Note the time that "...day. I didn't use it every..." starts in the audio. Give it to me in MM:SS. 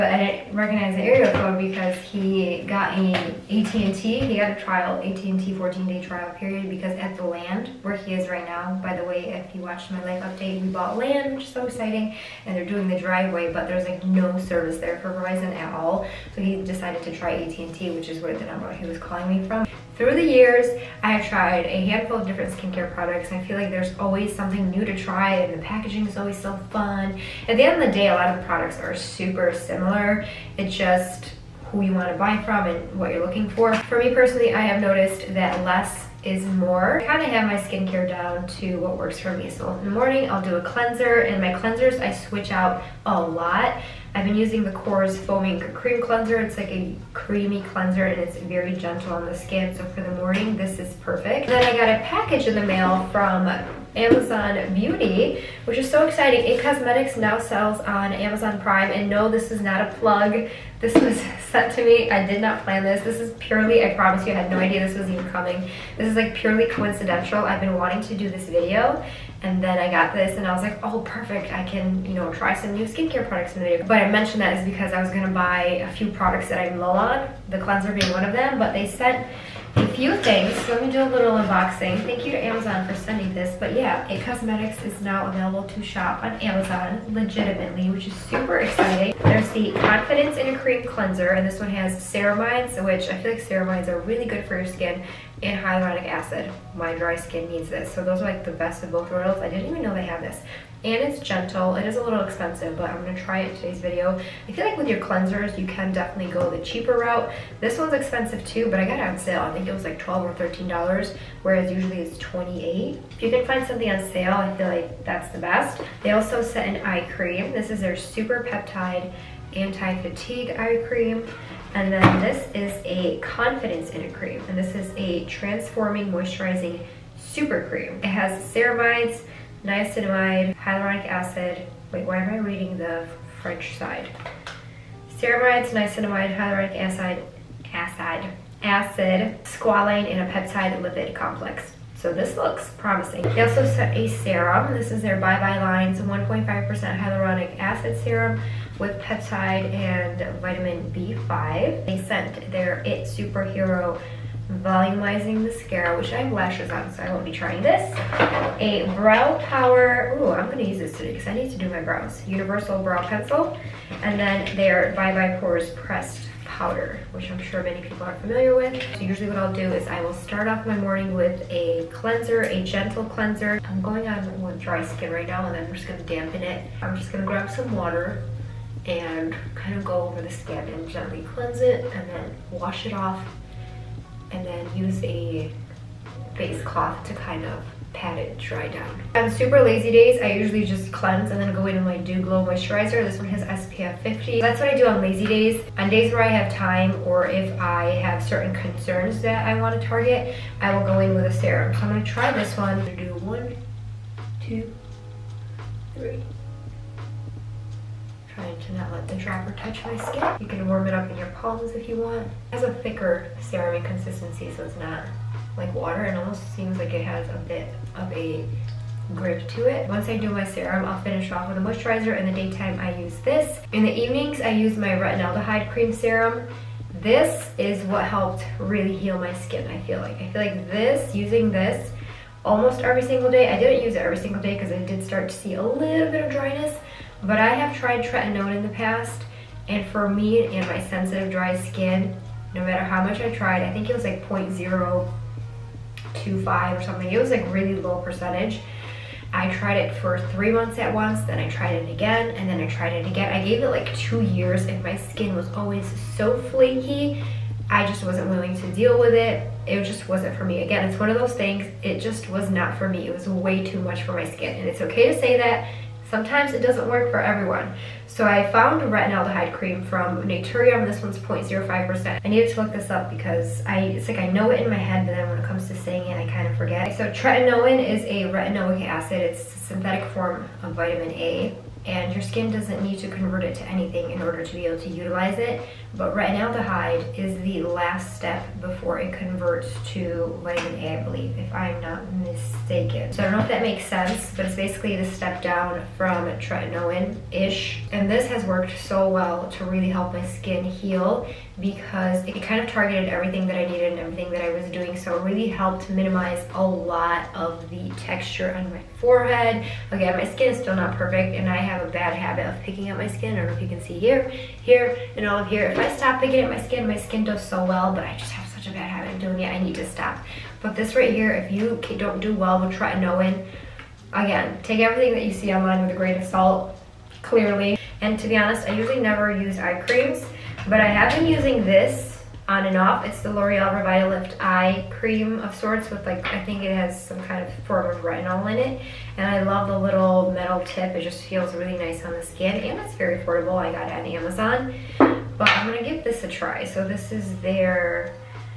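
03:53.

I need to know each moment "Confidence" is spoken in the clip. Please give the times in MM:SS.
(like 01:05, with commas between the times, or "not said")
01:29, 02:03.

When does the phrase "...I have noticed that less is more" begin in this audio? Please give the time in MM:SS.
00:34.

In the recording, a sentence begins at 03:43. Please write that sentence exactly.
In the evenings, I use my retinaldehyde cream serum.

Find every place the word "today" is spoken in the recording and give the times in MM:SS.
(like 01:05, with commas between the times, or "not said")
01:43, 02:40.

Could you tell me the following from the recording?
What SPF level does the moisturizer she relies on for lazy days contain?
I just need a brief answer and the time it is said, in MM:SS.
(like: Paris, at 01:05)
50, at 03:13.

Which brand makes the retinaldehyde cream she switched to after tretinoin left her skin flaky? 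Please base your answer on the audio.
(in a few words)
Naturium.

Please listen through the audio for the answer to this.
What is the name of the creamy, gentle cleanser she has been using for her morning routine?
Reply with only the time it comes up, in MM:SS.
00:44.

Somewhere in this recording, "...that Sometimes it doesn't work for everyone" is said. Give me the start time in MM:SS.
04:25.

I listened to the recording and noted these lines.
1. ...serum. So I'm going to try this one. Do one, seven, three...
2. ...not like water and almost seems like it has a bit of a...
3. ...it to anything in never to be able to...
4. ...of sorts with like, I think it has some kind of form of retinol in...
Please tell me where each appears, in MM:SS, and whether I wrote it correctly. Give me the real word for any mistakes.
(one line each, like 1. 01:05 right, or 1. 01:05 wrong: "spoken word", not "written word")
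1. 03:21 wrong: "two", not "seven"
2. 03:34 right
3. 04:43 wrong: "order", not "never"
4. 05:35 right.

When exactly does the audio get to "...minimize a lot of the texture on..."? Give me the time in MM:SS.
05:05.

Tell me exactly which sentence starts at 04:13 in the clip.
I gave it like two years and my skin was always so flaky.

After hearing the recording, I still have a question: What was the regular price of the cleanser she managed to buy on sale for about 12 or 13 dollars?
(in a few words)
$28.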